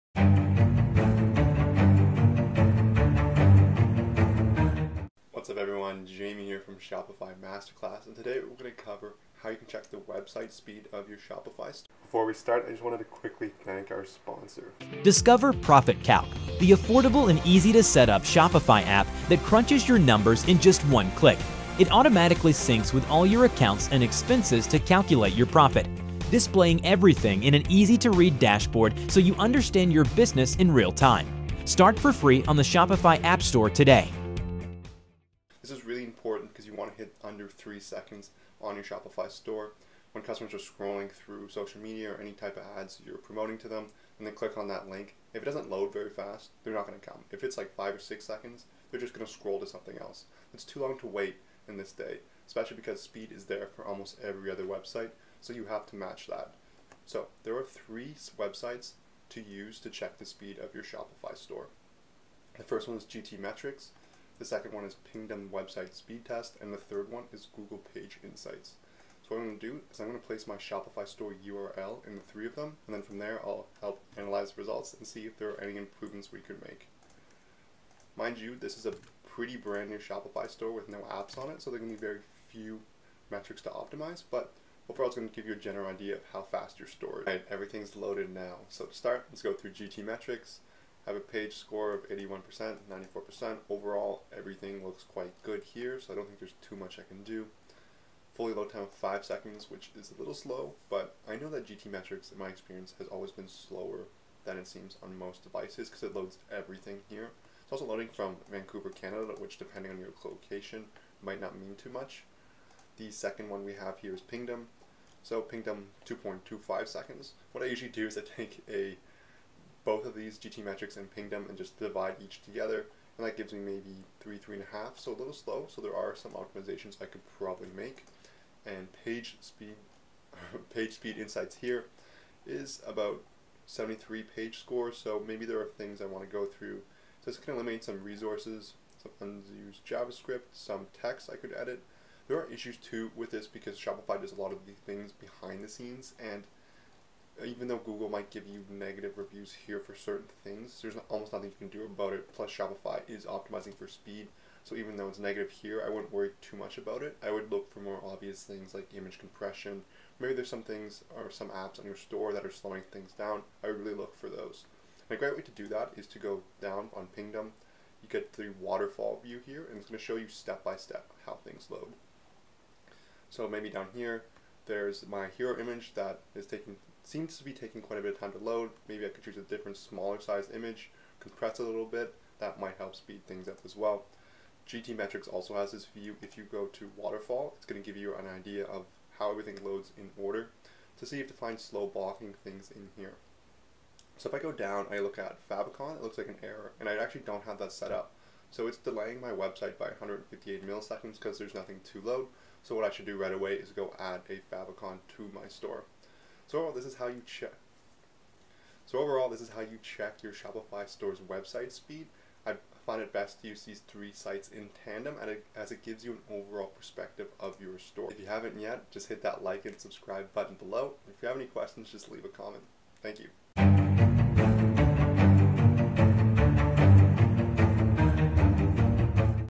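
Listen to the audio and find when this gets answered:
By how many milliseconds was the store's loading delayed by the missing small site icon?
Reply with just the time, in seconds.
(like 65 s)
199 s.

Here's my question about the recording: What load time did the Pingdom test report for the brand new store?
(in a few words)
2.25 seconds.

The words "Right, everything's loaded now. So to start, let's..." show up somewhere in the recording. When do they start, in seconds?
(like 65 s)
87 s.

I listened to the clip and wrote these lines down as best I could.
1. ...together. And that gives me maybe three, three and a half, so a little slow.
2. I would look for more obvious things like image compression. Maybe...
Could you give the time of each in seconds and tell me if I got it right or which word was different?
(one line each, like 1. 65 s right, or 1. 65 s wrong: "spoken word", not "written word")
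1. 122 s right
2. 157 s right.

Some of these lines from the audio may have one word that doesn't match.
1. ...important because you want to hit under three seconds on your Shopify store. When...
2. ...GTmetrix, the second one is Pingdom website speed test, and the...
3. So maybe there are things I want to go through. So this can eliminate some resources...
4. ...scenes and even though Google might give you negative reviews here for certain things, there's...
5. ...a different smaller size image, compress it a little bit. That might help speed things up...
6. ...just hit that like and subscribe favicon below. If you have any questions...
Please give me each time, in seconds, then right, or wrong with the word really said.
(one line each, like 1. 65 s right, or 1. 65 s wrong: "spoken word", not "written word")
1. 36 s right
2. 63 s right
3. 134 s right
4. 145 s right
5. 179 s right
6. 218 s wrong: "button", not "favicon".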